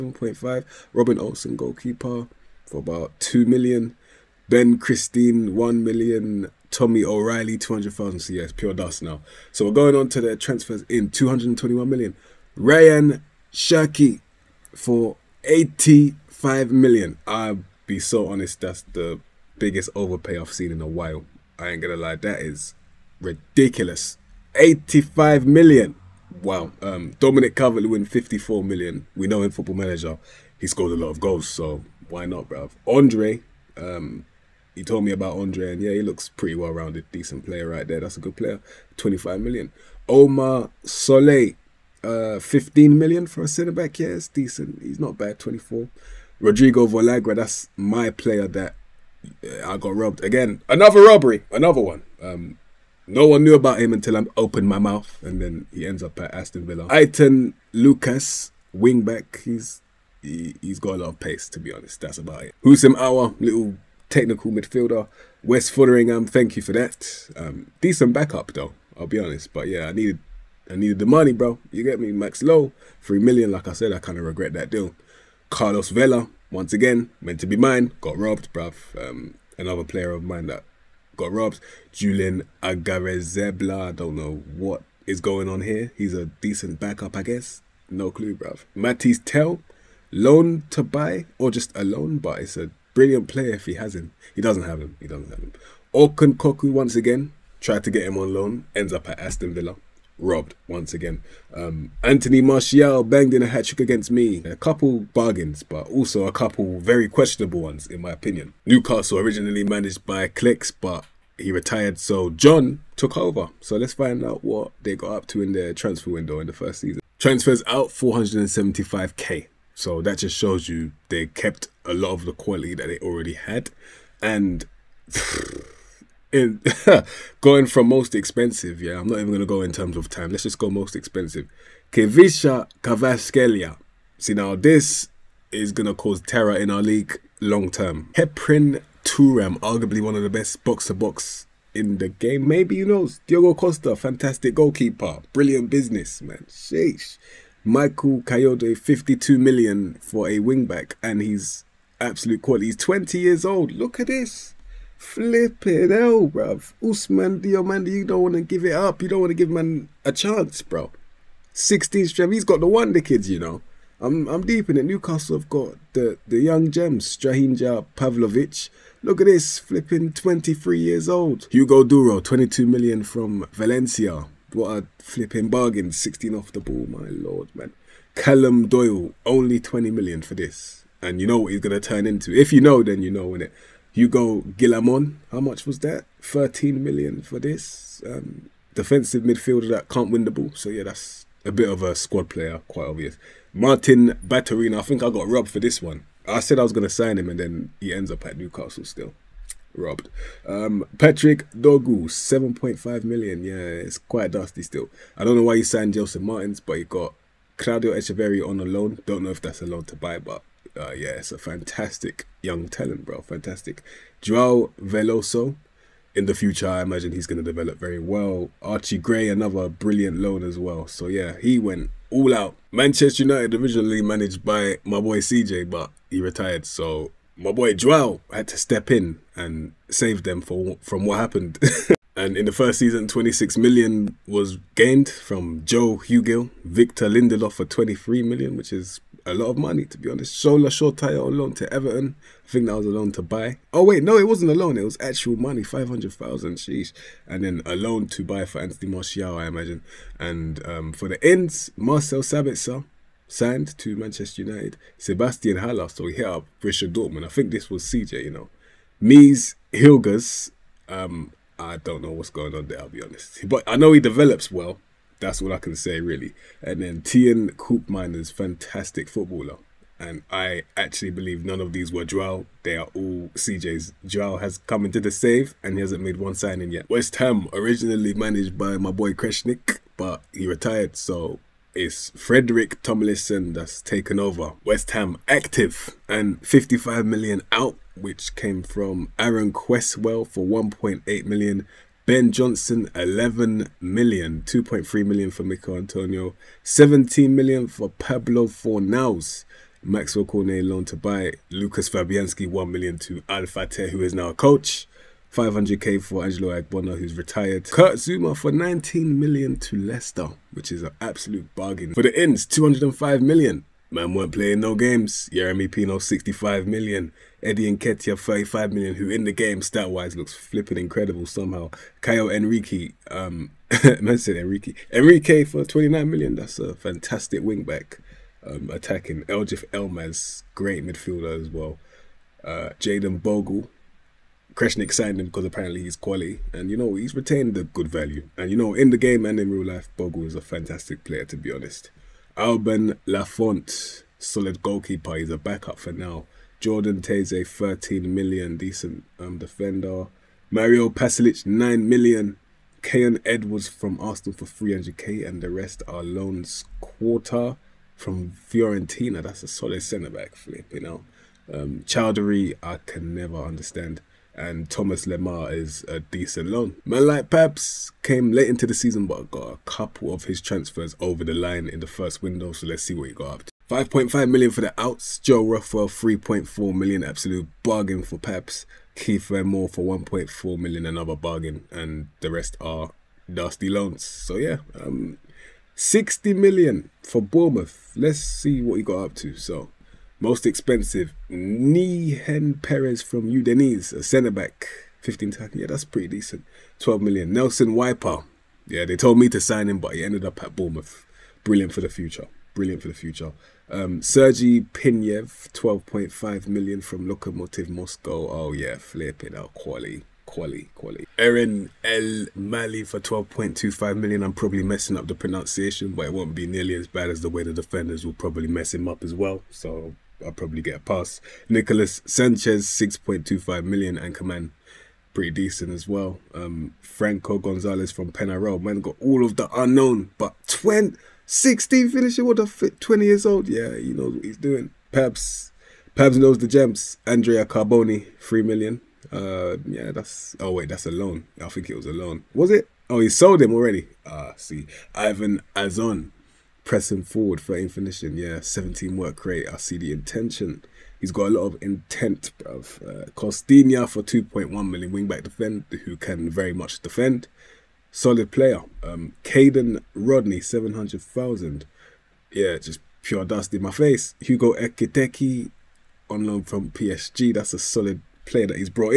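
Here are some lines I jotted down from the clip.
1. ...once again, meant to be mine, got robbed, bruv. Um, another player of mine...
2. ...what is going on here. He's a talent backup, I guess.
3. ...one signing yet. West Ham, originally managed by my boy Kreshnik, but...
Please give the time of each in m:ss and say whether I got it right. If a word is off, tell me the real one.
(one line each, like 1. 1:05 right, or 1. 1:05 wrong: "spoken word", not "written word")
1. 1:16 right
2. 1:24 wrong: "decent", not "talent"
3. 4:36 right.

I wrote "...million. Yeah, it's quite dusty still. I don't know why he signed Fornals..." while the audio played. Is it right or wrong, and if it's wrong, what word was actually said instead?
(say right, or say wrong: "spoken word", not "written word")
wrong: "Joseph", not "Fornals".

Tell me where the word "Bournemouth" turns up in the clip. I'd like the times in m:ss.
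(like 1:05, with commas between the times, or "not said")
6:27, 6:40.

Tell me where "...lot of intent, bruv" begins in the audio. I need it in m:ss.
7:31.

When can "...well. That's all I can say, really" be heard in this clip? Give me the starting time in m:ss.
4:24.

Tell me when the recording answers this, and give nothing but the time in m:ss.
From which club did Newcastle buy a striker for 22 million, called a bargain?
2:53.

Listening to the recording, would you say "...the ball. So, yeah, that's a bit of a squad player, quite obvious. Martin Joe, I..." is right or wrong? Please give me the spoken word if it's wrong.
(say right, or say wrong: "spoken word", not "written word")
wrong: "Baturina", not "Joe".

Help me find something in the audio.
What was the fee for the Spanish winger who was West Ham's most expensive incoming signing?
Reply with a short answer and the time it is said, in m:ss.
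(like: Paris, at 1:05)
65 million, at 5:15.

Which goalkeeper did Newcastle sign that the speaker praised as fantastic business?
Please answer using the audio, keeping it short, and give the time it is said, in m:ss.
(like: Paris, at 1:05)
Diogo Costa, at 2:23.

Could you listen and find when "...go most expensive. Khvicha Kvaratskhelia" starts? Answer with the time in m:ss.
2:10.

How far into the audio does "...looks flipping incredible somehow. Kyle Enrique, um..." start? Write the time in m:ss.
5:20.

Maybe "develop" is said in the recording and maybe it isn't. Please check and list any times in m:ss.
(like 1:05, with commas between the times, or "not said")
3:37, 4:24.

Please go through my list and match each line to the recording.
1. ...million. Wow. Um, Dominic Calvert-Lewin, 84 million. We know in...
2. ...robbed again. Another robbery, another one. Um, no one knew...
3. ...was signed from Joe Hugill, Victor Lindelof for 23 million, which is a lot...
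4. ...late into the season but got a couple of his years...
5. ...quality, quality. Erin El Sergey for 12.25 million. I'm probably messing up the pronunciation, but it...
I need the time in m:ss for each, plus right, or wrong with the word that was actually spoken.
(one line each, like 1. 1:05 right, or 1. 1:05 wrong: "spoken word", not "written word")
1. 0:25 wrong: "54", not "84"
2. 0:49 right
3. 3:54 wrong: "gained", not "signed"
4. 6:08 wrong: "transfers", not "years"
5. 6:50 wrong: "Mali", not "Sergey".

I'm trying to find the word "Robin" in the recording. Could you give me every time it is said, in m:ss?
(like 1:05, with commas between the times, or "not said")
0:00.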